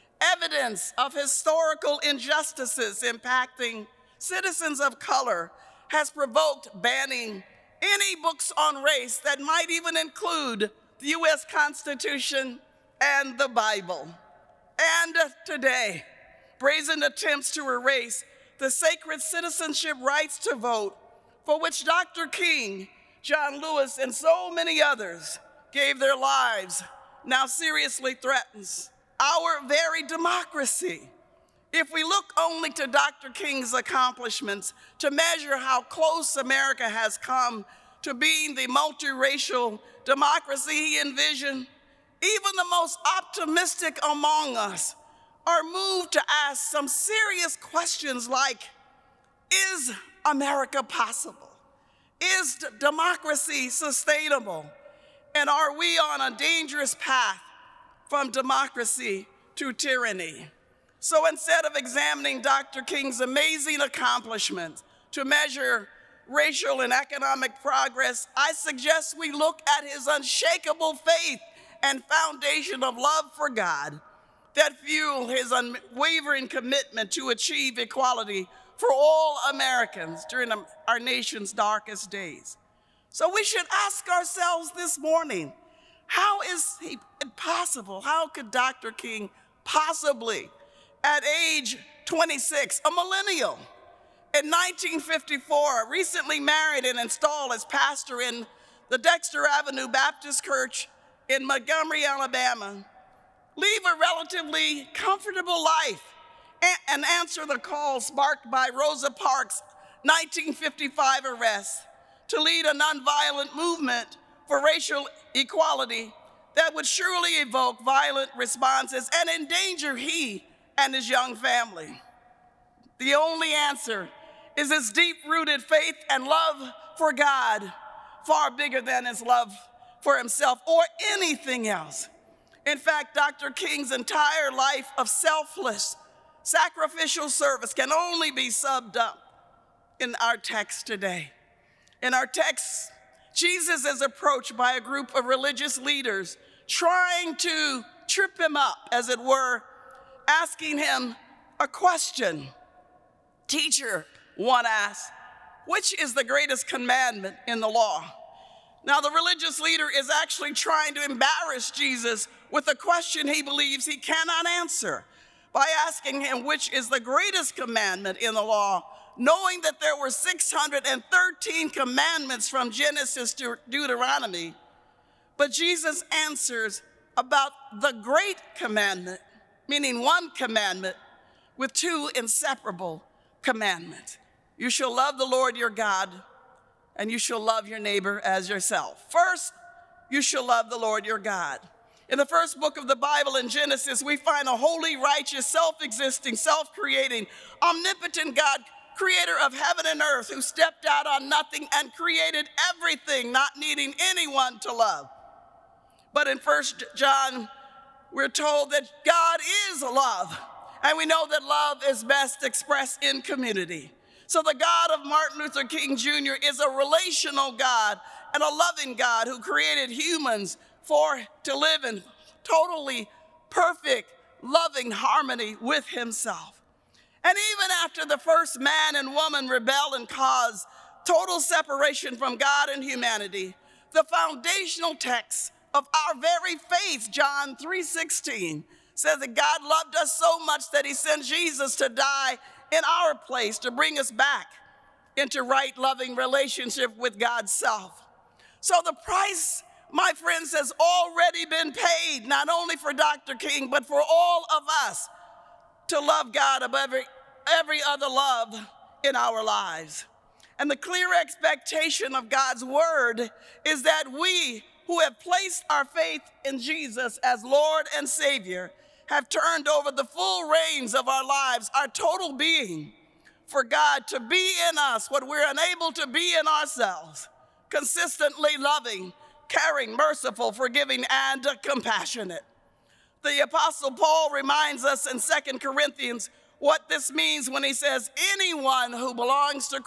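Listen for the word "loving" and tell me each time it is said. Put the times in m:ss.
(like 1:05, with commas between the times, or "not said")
3:38, 3:44, 4:05, 4:38.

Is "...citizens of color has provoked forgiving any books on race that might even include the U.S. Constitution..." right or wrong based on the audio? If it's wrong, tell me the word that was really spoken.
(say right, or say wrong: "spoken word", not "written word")
wrong: "banning", not "forgiving".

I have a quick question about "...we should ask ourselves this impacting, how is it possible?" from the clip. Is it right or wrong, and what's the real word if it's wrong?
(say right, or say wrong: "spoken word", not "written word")
wrong: "morning", not "impacting".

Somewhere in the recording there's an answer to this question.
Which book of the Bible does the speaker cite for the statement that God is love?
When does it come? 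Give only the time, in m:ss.
3:26.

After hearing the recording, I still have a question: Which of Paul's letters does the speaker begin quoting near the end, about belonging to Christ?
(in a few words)
2 Corinthians.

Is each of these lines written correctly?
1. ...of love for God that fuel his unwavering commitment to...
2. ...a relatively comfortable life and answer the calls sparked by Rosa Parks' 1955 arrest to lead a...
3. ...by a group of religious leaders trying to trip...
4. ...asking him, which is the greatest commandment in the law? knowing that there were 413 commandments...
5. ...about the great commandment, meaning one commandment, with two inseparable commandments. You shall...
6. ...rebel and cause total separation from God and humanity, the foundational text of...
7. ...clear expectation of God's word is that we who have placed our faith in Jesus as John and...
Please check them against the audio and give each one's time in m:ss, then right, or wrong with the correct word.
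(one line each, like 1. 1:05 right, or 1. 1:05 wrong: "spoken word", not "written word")
1. 1:12 right
2. 1:43 right
3. 2:24 right
4. 2:45 wrong: "613", not "413"
5. 2:57 right
6. 3:49 right
7. 4:20 wrong: "Lord", not "John".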